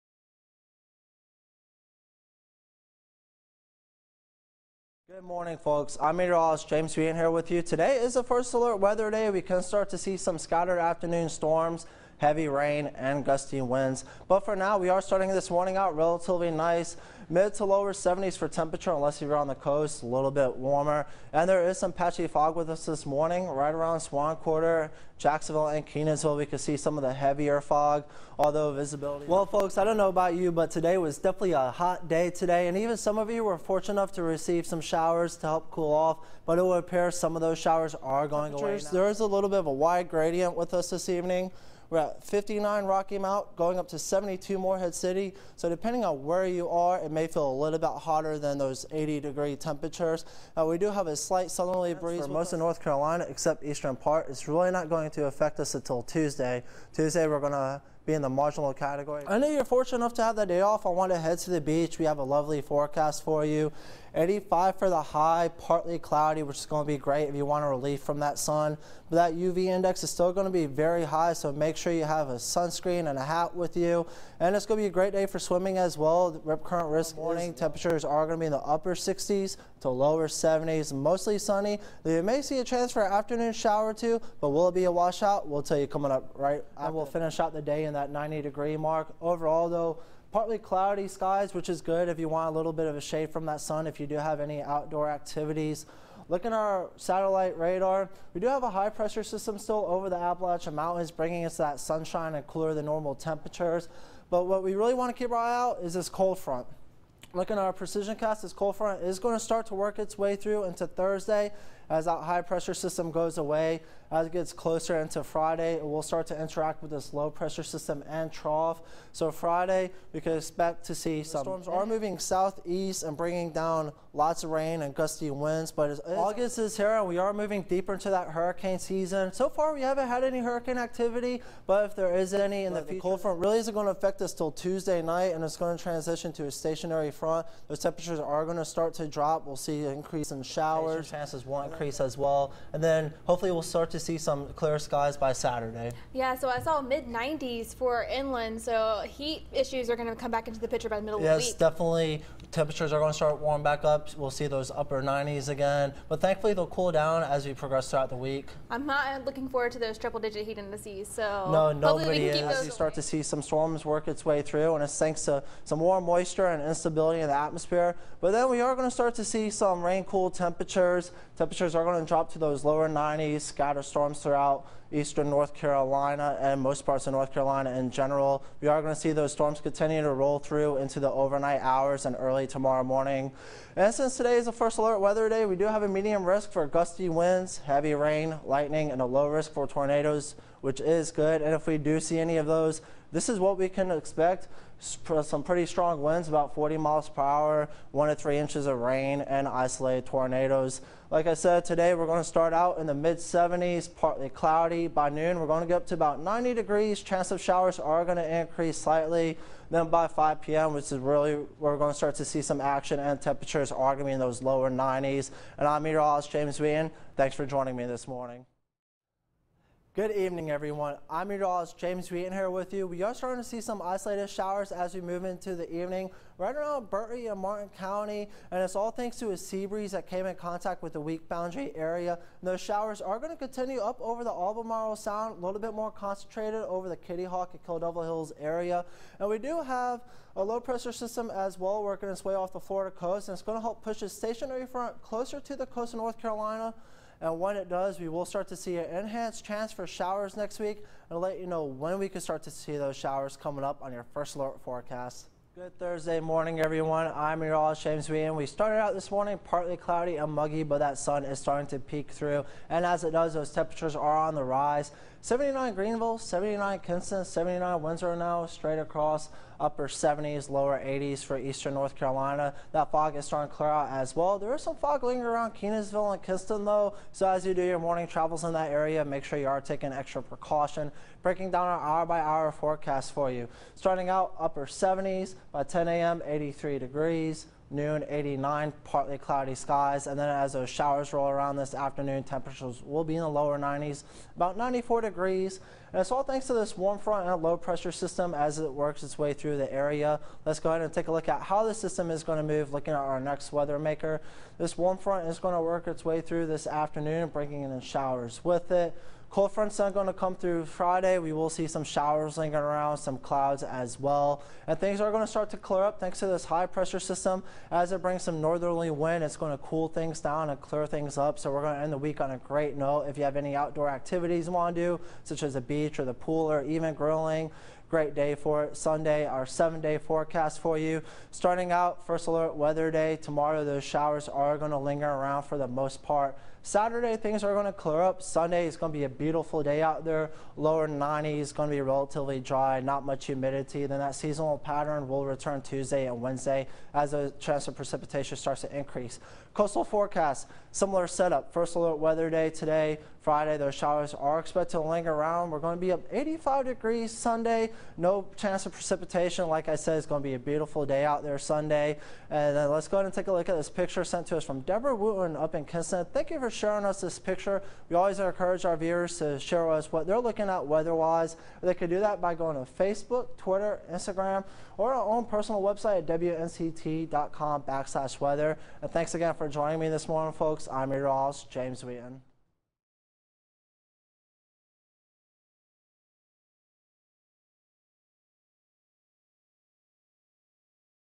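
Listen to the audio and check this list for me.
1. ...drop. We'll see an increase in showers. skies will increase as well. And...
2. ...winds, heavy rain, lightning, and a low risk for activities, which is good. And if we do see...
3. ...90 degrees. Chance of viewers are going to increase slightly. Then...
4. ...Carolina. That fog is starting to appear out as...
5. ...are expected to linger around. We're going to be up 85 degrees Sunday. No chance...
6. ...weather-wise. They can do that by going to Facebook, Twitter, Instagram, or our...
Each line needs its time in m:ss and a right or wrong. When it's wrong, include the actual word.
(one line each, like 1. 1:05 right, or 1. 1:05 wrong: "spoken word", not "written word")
1. 2:19 wrong: "chances", not "skies"
2. 3:07 wrong: "tornadoes", not "activities"
3. 3:26 wrong: "showers", not "viewers"
4. 4:31 wrong: "clear", not "appear"
5. 5:54 right
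6. 6:10 right.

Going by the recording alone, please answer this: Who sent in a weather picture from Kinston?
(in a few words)
Deborah Wooten.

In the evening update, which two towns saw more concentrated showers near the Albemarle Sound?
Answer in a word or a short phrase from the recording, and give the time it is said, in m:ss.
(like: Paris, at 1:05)
Kitty Hawk and Kill Devil Hills, at 3:56.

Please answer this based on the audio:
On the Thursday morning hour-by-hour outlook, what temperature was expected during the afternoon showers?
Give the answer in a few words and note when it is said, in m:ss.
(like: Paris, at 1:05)
94 degrees, at 4:54.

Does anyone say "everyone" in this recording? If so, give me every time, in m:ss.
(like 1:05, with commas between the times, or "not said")
3:40, 4:16.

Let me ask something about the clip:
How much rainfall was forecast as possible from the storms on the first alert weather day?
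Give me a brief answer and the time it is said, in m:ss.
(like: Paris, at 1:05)
1 to 3 inches, at 3:17.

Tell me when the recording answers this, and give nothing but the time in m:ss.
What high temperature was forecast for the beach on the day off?
1:04.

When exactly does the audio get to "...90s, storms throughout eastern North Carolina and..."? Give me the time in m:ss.
2:52.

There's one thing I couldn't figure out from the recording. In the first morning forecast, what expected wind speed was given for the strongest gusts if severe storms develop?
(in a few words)
40 miles per hour.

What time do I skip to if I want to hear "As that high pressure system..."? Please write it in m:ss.
1:51.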